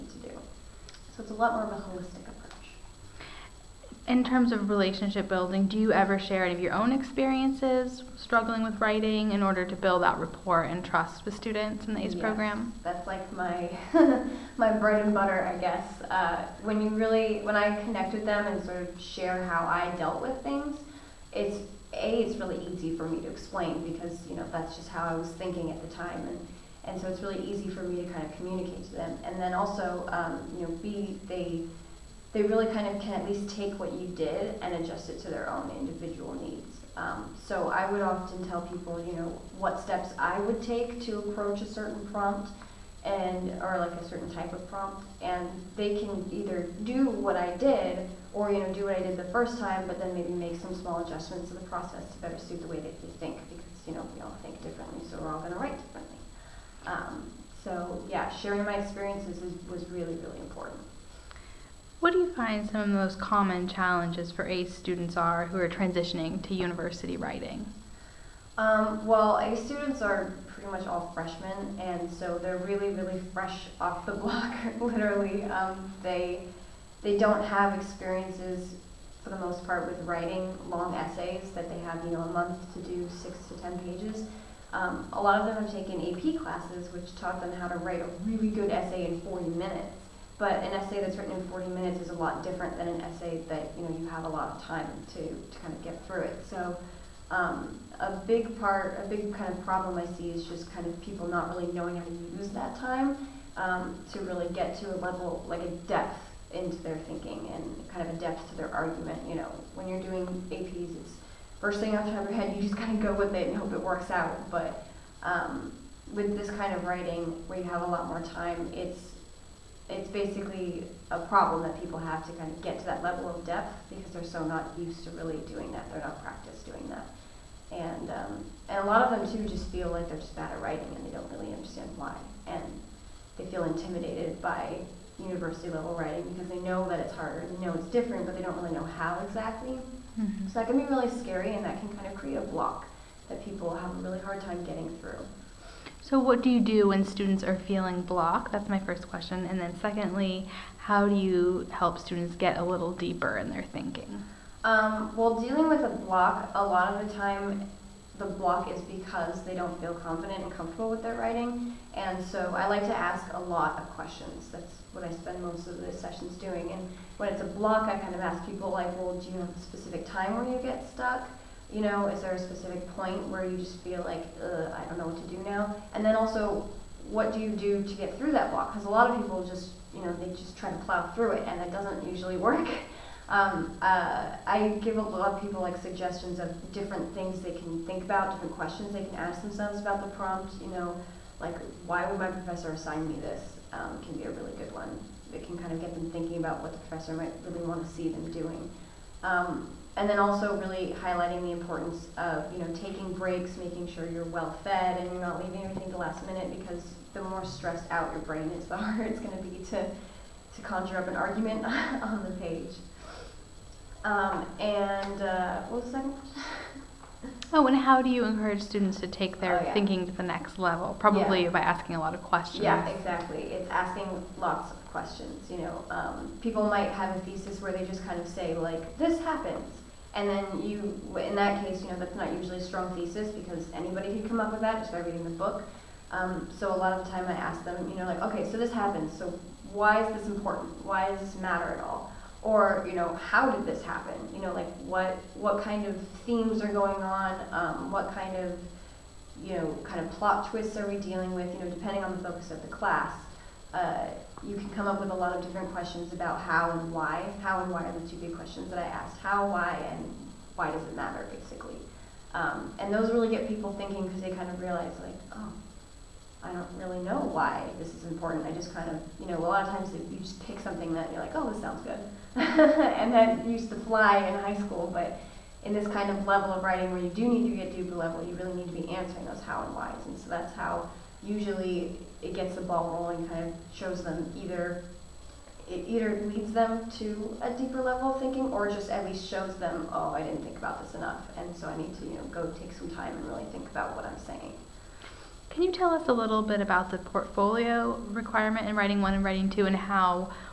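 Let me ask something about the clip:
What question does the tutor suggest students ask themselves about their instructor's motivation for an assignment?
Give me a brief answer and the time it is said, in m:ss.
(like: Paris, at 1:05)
Why would my professor assign me this?, at 3:11.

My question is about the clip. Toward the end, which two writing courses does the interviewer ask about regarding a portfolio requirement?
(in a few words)
Writing 1 and Writing 2.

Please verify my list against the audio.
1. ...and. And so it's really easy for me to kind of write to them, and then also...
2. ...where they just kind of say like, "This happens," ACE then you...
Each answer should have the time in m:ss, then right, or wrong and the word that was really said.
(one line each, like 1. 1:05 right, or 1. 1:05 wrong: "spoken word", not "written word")
1. 0:26 wrong: "communicate", not "write"
2. 3:47 wrong: "And", not "ACE".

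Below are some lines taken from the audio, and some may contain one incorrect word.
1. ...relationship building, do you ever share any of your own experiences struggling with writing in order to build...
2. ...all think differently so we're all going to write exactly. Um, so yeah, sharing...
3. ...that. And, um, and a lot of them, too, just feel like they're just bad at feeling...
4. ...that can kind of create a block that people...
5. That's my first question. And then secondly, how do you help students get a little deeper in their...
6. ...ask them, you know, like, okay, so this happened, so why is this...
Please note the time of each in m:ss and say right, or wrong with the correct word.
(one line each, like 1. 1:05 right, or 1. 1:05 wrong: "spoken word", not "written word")
1. 0:04 right
2. 0:54 wrong: "differently", not "exactly"
3. 2:06 wrong: "writing", not "feeling"
4. 2:21 right
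5. 2:28 right
6. 3:57 right.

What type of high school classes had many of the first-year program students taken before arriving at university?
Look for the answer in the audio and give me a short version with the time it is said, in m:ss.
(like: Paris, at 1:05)
AP classes, at 1:25.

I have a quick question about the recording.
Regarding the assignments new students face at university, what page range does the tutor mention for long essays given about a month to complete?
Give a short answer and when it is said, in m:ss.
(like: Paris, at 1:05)
6 to 10 pages, at 1:23.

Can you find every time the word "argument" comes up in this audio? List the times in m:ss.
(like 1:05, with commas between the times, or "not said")
1:48, 3:31.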